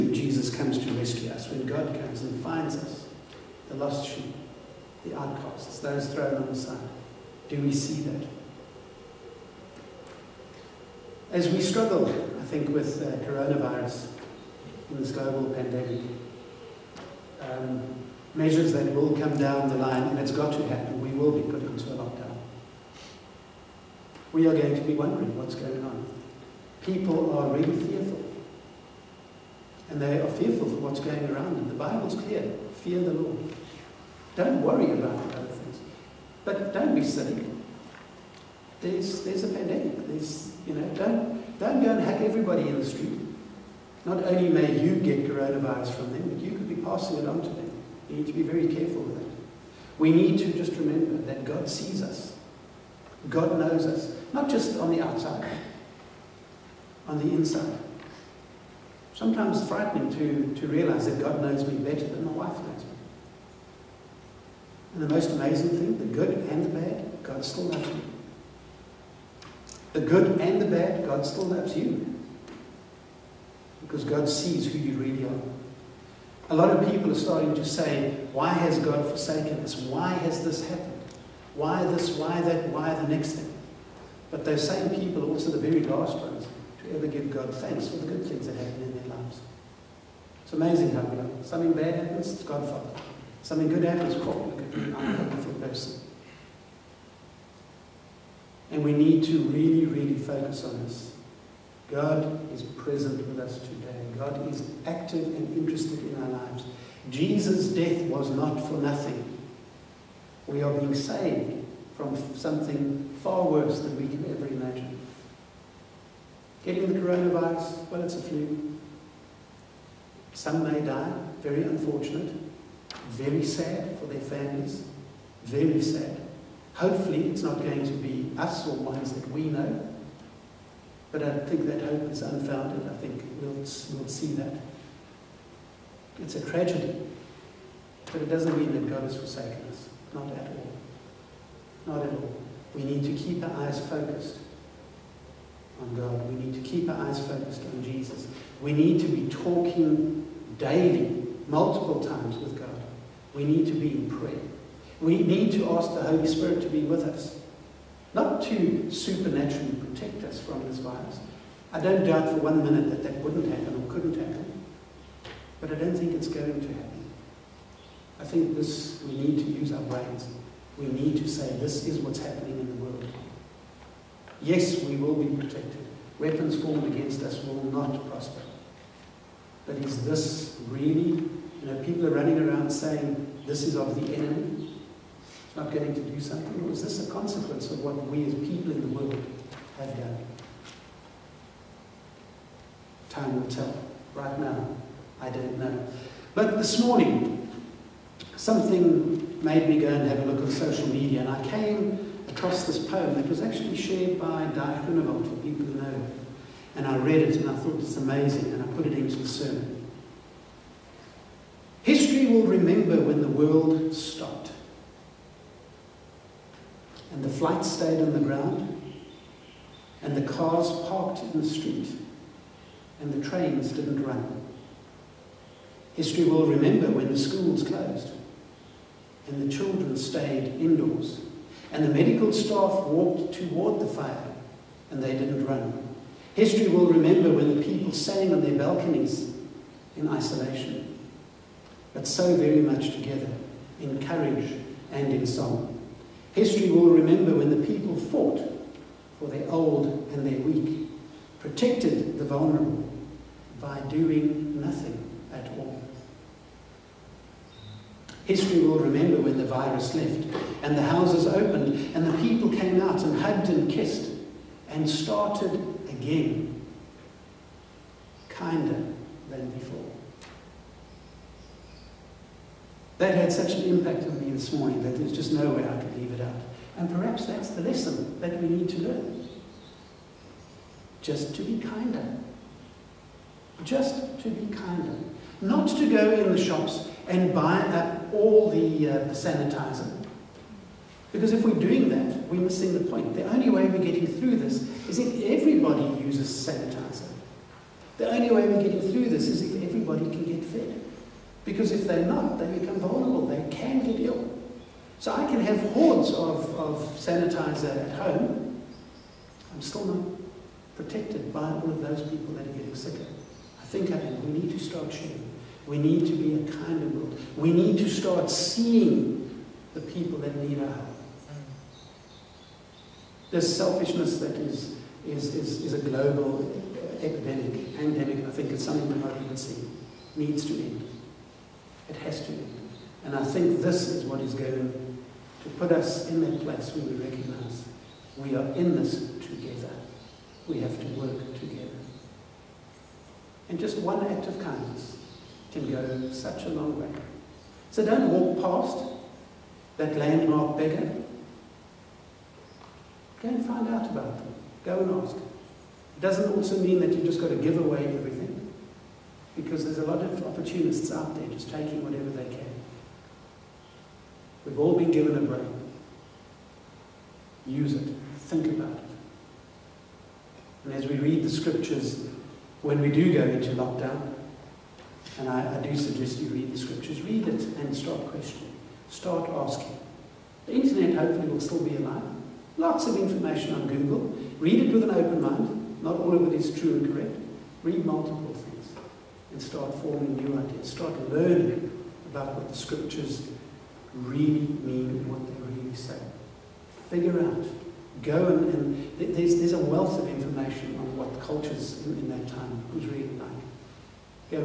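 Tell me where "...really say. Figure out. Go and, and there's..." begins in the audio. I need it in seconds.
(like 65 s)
395 s.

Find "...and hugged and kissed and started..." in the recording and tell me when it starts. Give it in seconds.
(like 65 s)
263 s.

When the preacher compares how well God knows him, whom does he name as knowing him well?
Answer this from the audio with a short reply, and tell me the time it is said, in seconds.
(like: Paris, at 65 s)
my wife, at 62 s.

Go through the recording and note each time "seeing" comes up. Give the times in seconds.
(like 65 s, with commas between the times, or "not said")
318 s, 329 s.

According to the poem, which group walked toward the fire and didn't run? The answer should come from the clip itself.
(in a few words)
the medical staff.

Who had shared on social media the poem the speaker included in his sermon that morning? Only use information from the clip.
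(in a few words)
Di Groenewald.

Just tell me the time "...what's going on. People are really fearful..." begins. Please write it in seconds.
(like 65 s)
25 s.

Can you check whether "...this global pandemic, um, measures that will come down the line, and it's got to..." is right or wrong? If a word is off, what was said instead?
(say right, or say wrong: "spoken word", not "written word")
right.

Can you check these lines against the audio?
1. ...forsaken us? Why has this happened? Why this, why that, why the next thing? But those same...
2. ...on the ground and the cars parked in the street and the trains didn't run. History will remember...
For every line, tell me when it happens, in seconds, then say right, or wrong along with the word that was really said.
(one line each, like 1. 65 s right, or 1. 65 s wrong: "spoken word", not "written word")
1. 79 s right
2. 218 s right.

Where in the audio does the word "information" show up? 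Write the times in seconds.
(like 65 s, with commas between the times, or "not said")
382 s, 400 s.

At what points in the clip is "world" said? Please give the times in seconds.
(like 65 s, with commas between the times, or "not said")
172 s, 188 s, 213 s, 316 s.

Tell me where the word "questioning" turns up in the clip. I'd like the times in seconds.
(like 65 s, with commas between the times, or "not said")
378 s.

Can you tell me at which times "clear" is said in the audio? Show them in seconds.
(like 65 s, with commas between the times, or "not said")
32 s.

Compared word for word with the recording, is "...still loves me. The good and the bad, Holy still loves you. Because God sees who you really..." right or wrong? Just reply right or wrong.
wrong.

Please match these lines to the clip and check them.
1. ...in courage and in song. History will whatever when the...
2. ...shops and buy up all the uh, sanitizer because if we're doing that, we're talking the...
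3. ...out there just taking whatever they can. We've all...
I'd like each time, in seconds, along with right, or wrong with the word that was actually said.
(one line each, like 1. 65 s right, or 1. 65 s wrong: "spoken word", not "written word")
1. 243 s wrong: "remember", not "whatever"
2. 286 s wrong: "missing", not "talking"
3. 360 s right.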